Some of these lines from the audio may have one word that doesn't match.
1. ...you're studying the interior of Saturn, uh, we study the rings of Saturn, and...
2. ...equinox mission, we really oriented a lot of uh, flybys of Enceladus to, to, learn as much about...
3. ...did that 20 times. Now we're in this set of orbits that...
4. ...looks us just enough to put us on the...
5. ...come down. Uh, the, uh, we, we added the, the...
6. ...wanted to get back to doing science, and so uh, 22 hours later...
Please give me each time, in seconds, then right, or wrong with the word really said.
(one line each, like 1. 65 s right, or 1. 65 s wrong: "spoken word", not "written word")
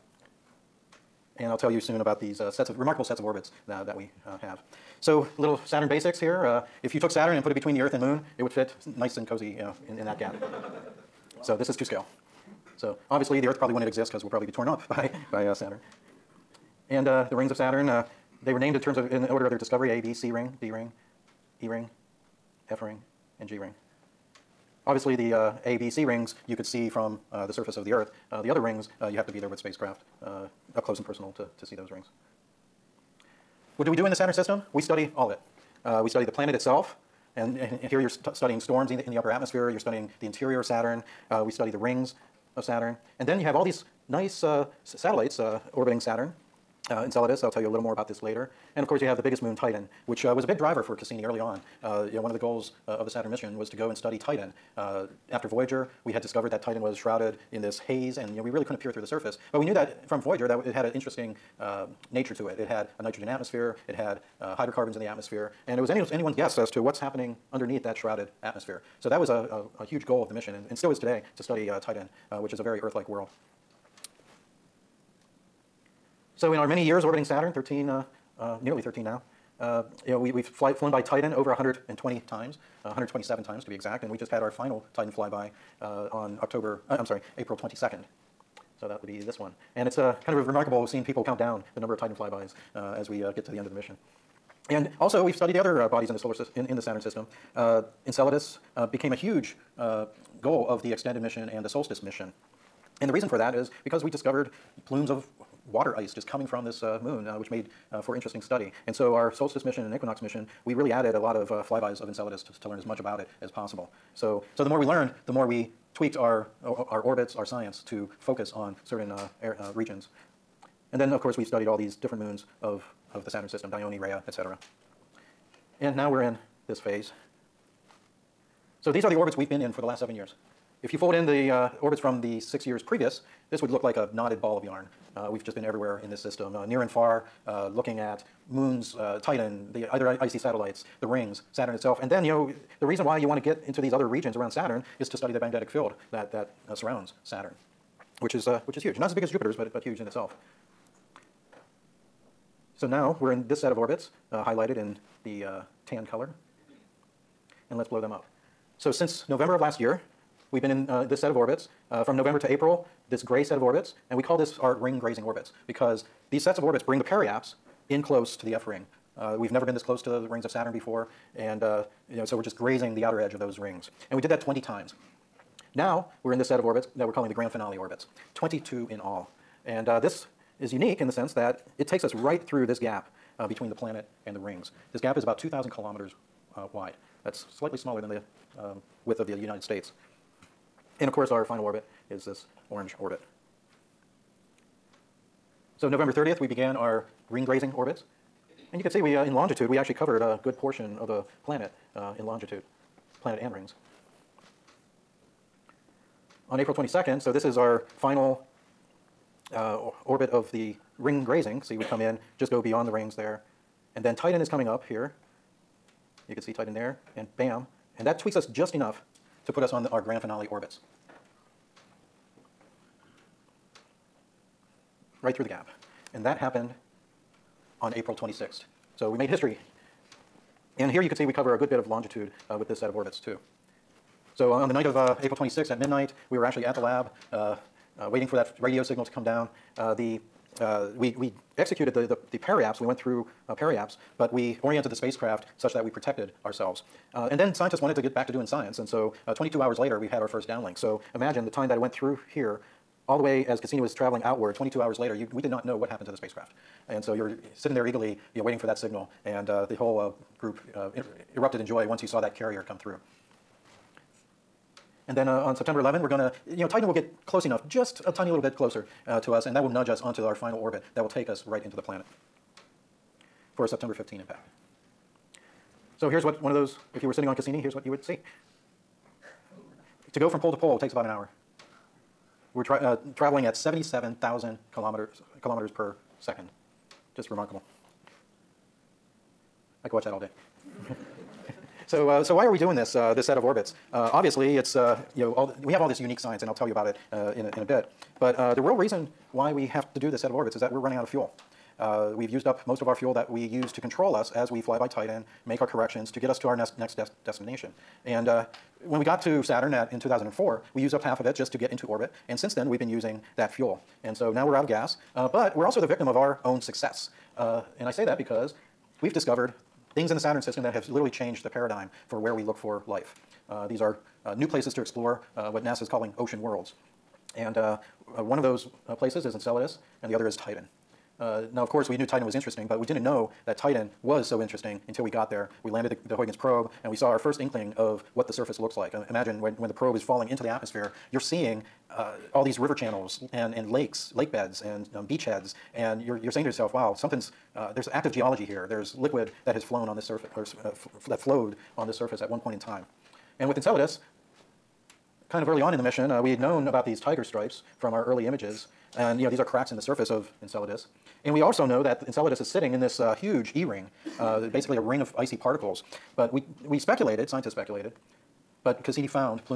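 1. 39 s right
2. 109 s wrong: "added", not "oriented"
3. 174 s right
4. 218 s wrong: "tweaks", not "looks"
5. 239 s wrong: "executed", not "added"
6. 247 s right.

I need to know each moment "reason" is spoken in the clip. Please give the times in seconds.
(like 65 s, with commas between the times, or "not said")
103 s, 142 s, 298 s.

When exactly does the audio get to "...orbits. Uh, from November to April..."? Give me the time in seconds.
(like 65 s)
161 s.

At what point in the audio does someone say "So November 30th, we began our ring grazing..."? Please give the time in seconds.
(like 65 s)
195 s.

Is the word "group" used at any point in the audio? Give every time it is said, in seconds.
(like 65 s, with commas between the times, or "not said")
260 s.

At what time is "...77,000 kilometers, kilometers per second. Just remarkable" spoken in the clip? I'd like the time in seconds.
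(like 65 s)
283 s.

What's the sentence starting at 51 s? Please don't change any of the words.
you know, one of the goals uh, of the Saturn mission was to go and study Titan.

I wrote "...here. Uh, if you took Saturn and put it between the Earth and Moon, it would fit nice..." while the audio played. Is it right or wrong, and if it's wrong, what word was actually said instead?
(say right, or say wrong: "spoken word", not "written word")
right.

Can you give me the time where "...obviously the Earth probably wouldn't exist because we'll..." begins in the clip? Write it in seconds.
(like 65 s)
13 s.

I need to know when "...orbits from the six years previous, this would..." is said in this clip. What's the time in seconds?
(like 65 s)
131 s.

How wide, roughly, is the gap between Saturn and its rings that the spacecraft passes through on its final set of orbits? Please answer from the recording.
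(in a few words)
2,000 kilometers.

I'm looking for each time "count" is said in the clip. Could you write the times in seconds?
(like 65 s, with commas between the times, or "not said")
91 s.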